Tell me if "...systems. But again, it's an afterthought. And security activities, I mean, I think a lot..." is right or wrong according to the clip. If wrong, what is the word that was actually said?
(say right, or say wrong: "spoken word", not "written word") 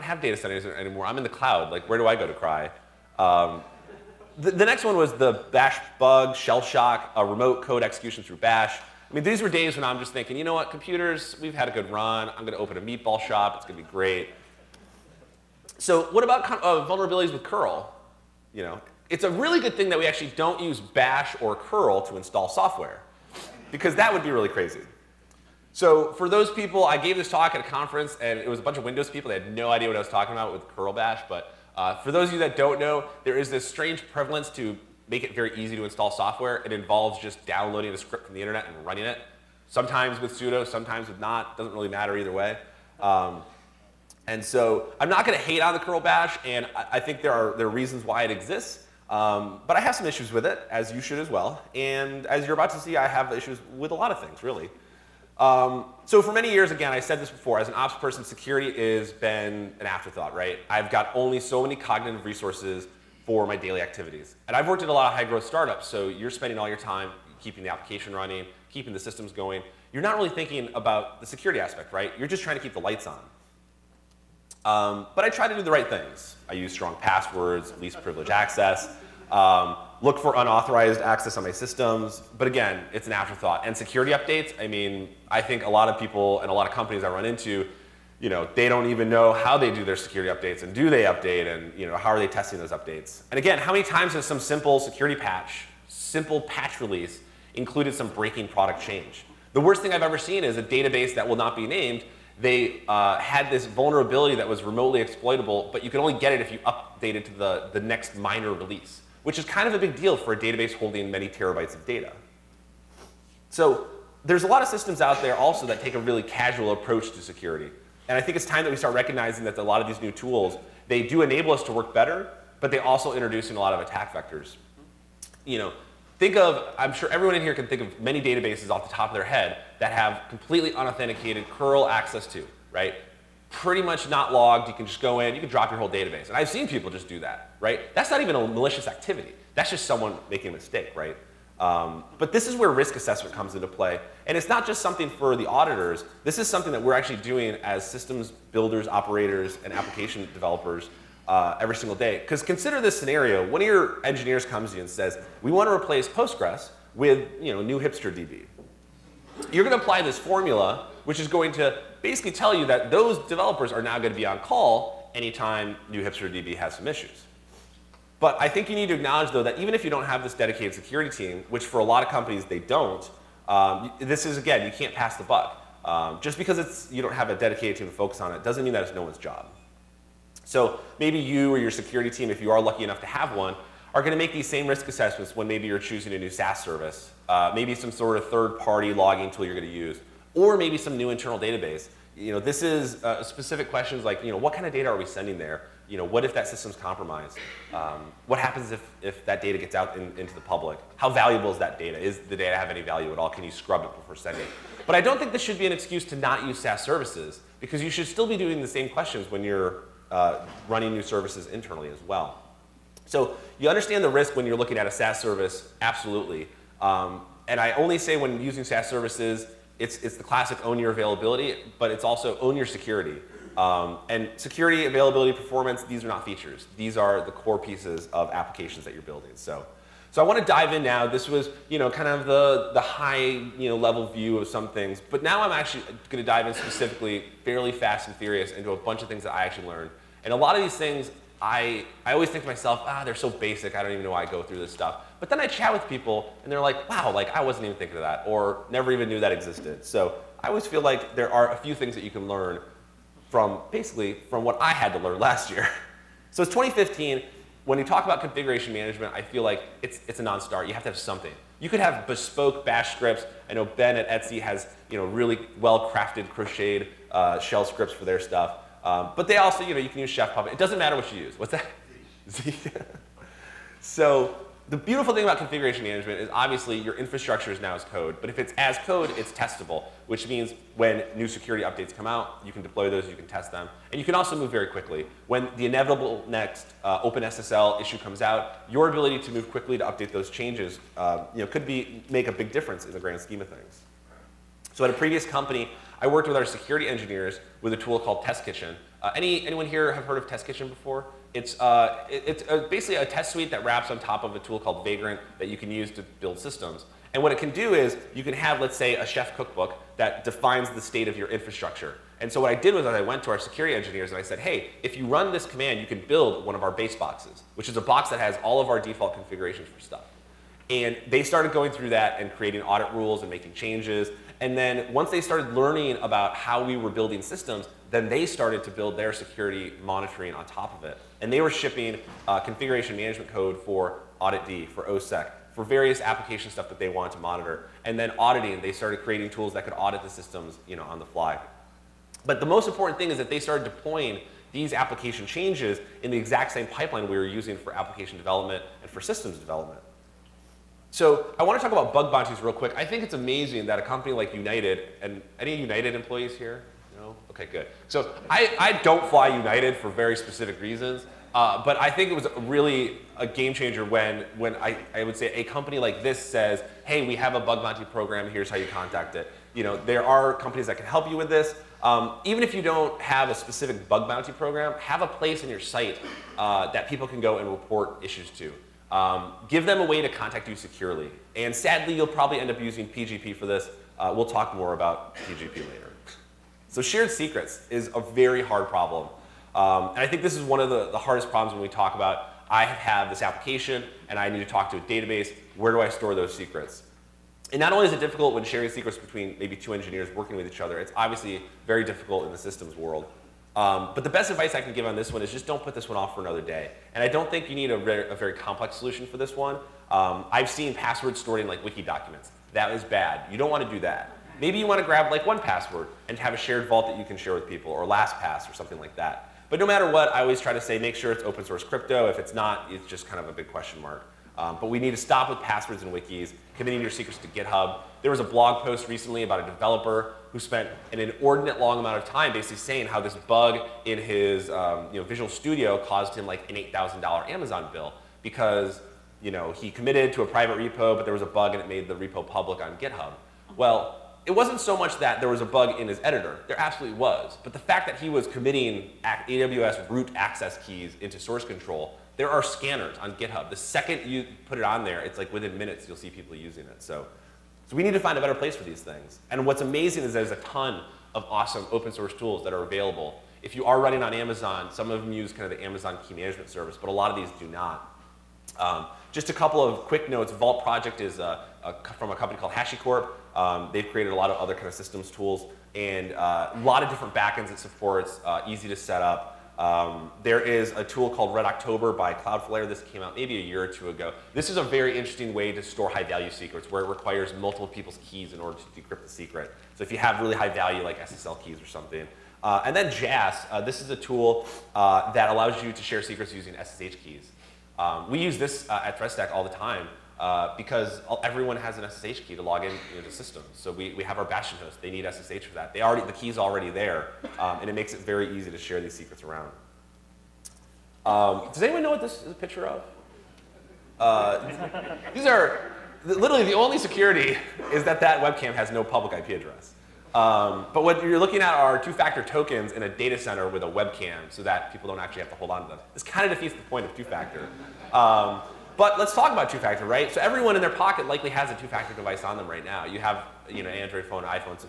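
wrong: "updates", not "activities".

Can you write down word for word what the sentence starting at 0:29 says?
They had no idea what I was talking about with curl bash.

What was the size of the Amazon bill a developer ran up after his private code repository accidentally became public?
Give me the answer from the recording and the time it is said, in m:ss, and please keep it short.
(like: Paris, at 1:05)
$8,000, at 7:16.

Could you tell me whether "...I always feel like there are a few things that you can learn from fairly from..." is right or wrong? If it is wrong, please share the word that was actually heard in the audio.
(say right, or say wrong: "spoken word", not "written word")
wrong: "basically", not "fairly".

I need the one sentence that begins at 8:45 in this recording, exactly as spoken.
This kind of defeats the point of two-factor.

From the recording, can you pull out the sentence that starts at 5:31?
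And they were shipping uh, configuration management code for Audit D, for OSSEC, for various application stuff that they wanted to monitor.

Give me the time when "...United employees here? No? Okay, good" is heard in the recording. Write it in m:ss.
5:55.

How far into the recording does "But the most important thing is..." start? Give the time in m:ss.
5:42.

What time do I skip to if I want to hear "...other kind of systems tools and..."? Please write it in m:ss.
7:54.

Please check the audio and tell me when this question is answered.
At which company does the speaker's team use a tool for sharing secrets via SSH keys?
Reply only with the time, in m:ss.
8:18.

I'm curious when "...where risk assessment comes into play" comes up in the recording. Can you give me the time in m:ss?
2:22.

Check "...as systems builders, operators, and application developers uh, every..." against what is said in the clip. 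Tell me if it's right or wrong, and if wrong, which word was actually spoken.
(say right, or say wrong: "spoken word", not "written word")
right.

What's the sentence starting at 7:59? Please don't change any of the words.
Um, there is a tool called Red October by Cloudflare.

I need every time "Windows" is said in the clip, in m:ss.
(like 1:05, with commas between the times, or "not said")
0:28.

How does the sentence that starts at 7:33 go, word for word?
The second you put it on there, it's like within minutes you'll see people using it.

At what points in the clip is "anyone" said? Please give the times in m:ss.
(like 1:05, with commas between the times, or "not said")
4:59, 8:31.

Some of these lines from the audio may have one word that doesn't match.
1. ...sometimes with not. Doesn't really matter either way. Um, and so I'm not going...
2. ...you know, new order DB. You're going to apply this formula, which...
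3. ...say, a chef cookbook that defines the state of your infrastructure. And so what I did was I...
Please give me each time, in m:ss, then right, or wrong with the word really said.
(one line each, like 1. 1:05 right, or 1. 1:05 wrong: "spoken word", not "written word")
1. 0:40 right
2. 2:37 wrong: "hipster", not "order"
3. 5:08 right.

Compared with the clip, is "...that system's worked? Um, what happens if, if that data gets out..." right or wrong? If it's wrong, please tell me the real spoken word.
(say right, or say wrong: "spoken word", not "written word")
wrong: "compromised", not "worked".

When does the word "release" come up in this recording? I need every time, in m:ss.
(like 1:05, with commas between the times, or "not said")
1:36, 1:48.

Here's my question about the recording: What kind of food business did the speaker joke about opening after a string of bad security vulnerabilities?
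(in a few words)
Meatball shop.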